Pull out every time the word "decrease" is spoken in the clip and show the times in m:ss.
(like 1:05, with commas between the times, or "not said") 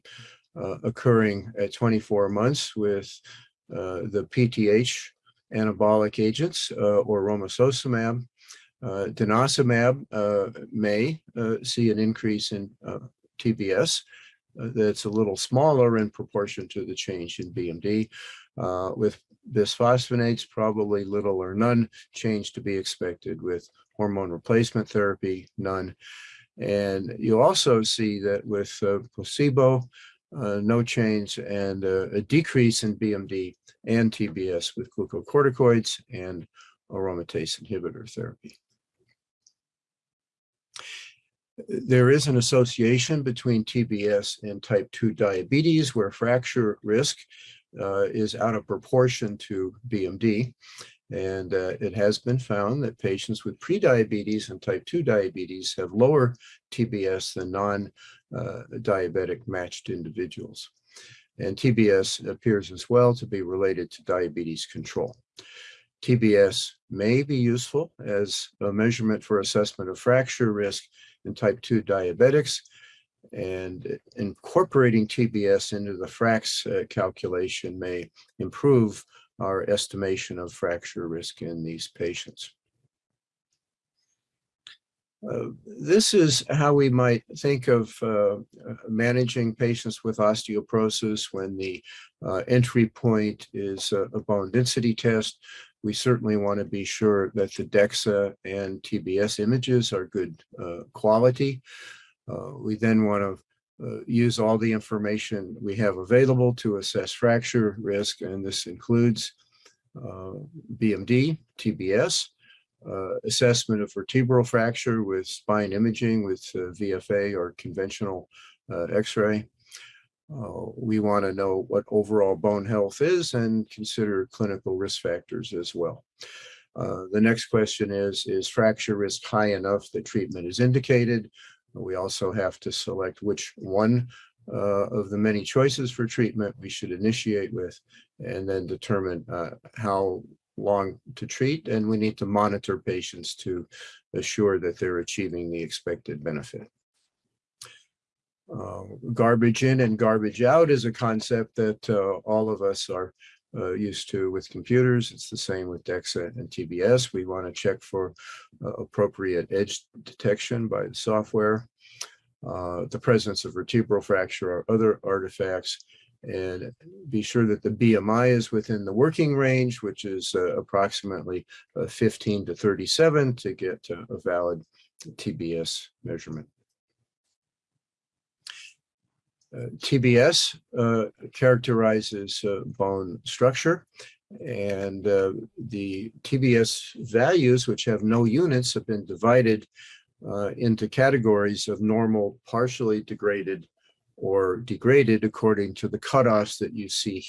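0:32.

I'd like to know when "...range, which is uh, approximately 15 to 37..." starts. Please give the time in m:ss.
2:49.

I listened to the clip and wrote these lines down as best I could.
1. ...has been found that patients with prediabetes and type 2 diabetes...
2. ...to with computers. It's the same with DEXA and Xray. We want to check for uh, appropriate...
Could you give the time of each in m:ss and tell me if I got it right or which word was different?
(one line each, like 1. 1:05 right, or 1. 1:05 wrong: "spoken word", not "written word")
1. 0:51 right
2. 2:34 wrong: "TBS", not "Xray".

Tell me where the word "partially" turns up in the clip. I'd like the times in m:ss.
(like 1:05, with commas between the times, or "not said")
3:12.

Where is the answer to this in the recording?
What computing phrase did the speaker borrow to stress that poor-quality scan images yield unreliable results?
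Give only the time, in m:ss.
2:29.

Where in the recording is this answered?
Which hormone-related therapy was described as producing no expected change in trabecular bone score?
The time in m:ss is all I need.
0:23.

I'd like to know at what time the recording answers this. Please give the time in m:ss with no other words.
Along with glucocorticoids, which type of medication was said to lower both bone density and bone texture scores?
0:36.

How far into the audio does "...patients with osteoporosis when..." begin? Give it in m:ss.
1:29.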